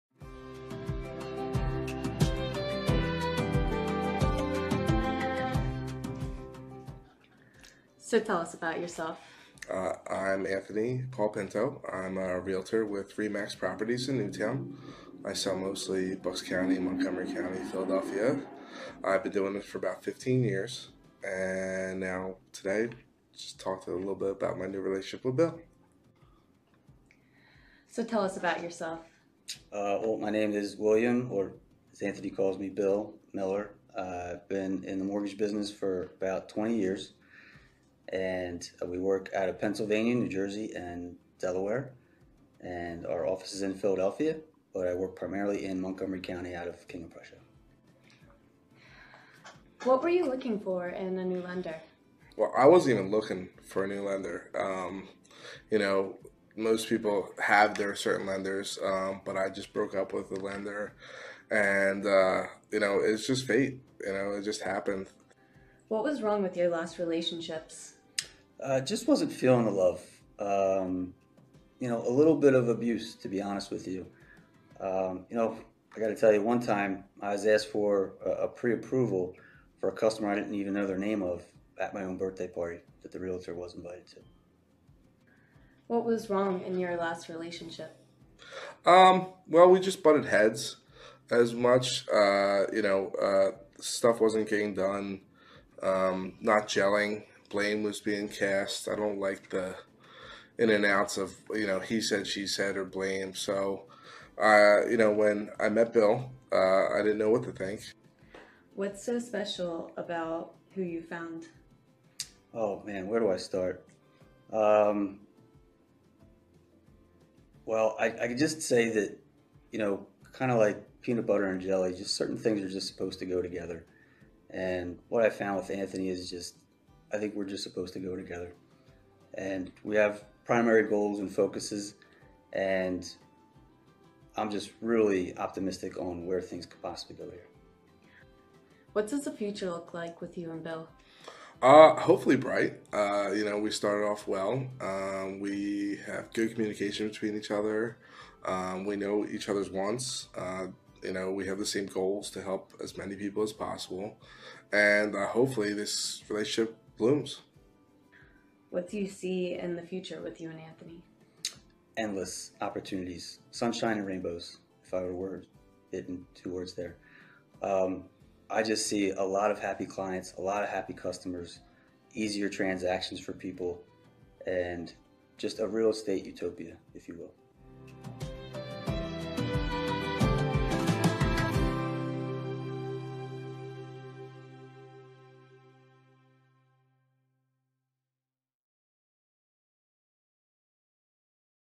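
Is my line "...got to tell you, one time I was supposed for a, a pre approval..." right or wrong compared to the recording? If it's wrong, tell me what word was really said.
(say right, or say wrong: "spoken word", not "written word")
wrong: "asked", not "supposed".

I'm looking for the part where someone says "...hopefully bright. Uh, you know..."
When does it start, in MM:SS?
02:21.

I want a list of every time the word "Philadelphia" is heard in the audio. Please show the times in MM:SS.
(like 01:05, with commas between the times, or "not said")
00:17, 00:43.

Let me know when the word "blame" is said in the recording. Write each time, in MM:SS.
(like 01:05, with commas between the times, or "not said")
01:37, 01:42.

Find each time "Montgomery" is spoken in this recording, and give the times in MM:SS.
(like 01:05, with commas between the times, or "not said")
00:16, 00:45.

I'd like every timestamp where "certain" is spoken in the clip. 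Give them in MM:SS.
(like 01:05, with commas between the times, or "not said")
00:57, 02:02.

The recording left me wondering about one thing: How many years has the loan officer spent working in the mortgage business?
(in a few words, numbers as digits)
20.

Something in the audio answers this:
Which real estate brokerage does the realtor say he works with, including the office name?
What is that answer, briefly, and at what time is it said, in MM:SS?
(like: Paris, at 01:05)
Remax Properties, at 00:13.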